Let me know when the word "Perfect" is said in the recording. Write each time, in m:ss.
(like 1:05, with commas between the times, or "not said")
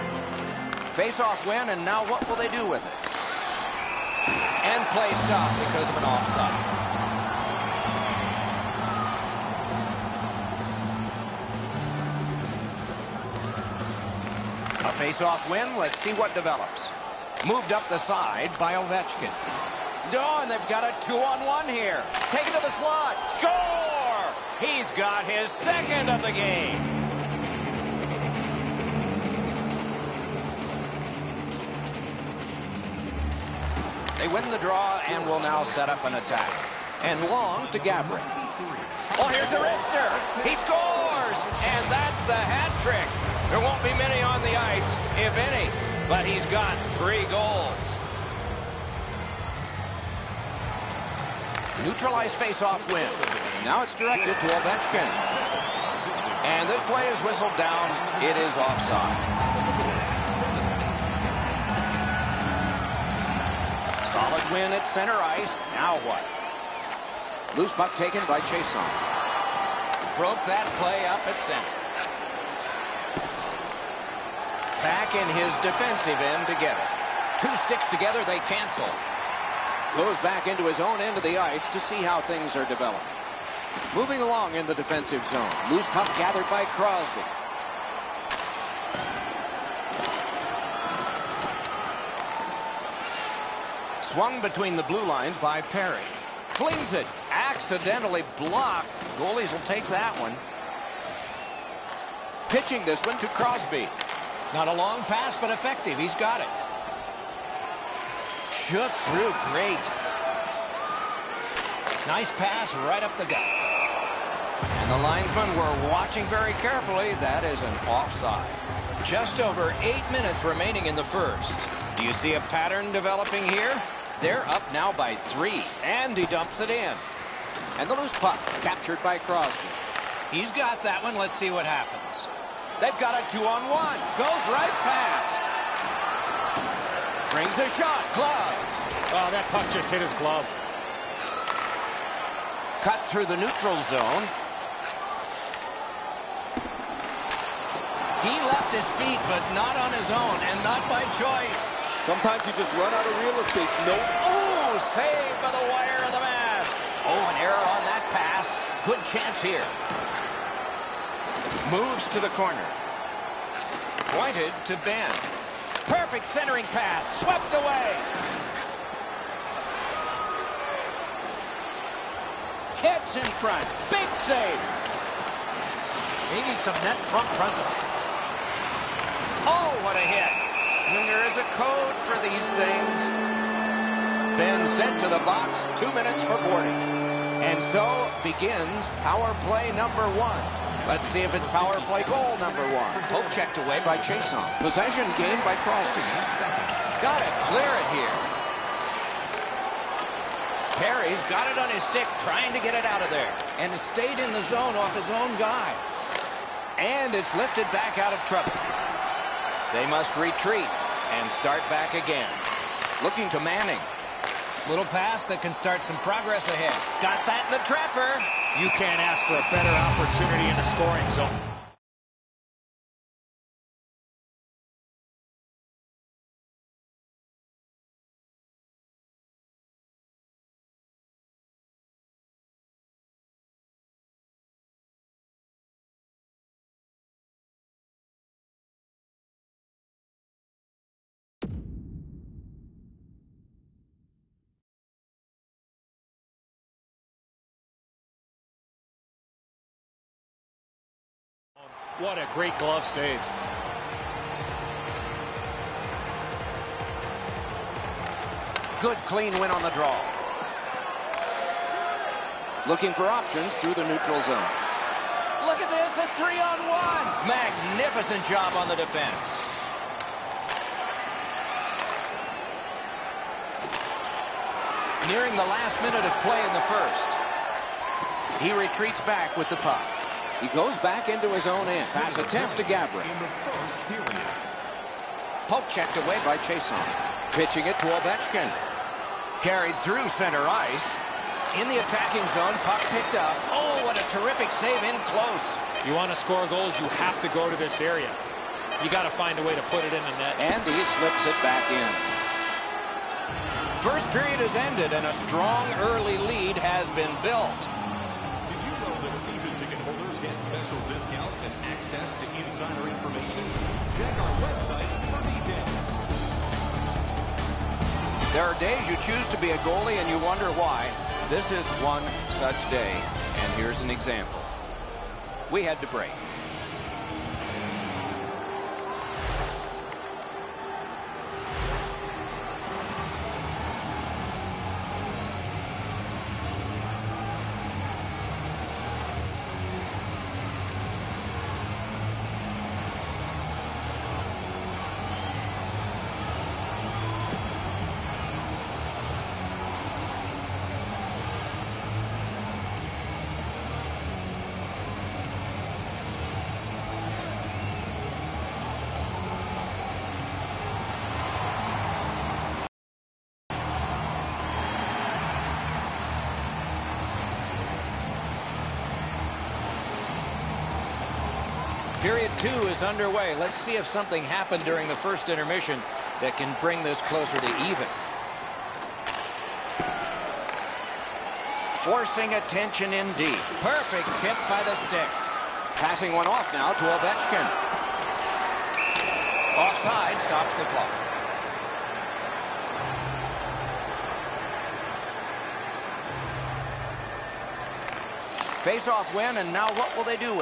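2:45, 6:23.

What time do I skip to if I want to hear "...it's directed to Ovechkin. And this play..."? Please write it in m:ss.
0:53.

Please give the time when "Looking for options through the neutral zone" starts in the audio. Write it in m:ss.
4:22.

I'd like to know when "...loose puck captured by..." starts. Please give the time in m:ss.
2:07.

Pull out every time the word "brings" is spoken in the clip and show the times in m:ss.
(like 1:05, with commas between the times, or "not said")
2:17, 6:16.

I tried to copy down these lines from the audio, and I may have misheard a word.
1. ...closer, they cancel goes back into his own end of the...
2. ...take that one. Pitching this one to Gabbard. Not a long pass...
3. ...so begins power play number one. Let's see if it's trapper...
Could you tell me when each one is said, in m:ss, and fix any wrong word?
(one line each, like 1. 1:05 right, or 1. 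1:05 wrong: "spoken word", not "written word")
1. 1:17 wrong: "together", not "closer"
2. 1:39 wrong: "Crosby", not "Gabbard"
3. 3:07 wrong: "power", not "trapper".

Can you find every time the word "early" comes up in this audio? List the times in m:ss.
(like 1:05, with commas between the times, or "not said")
5:05.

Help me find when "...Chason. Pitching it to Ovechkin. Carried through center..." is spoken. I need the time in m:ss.
4:46.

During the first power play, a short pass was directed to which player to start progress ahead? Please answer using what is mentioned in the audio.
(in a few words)
Manning.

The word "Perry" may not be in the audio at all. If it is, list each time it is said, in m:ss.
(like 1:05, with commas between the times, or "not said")
1:35, 3:20.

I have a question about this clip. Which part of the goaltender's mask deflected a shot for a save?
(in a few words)
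The wire.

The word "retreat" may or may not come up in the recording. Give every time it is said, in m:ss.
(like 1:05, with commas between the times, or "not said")
3:30, 4:38.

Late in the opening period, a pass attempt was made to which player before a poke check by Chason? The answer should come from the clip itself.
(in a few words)
Gabbard.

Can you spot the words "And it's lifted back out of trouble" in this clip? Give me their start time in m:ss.
3:26.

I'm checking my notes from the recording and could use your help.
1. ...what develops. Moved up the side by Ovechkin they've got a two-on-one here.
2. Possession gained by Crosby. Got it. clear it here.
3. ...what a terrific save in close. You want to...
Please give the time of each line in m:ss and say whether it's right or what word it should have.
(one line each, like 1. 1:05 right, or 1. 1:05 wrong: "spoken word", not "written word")
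1. 0:16 right
2. 3:14 right
3. 4:53 right.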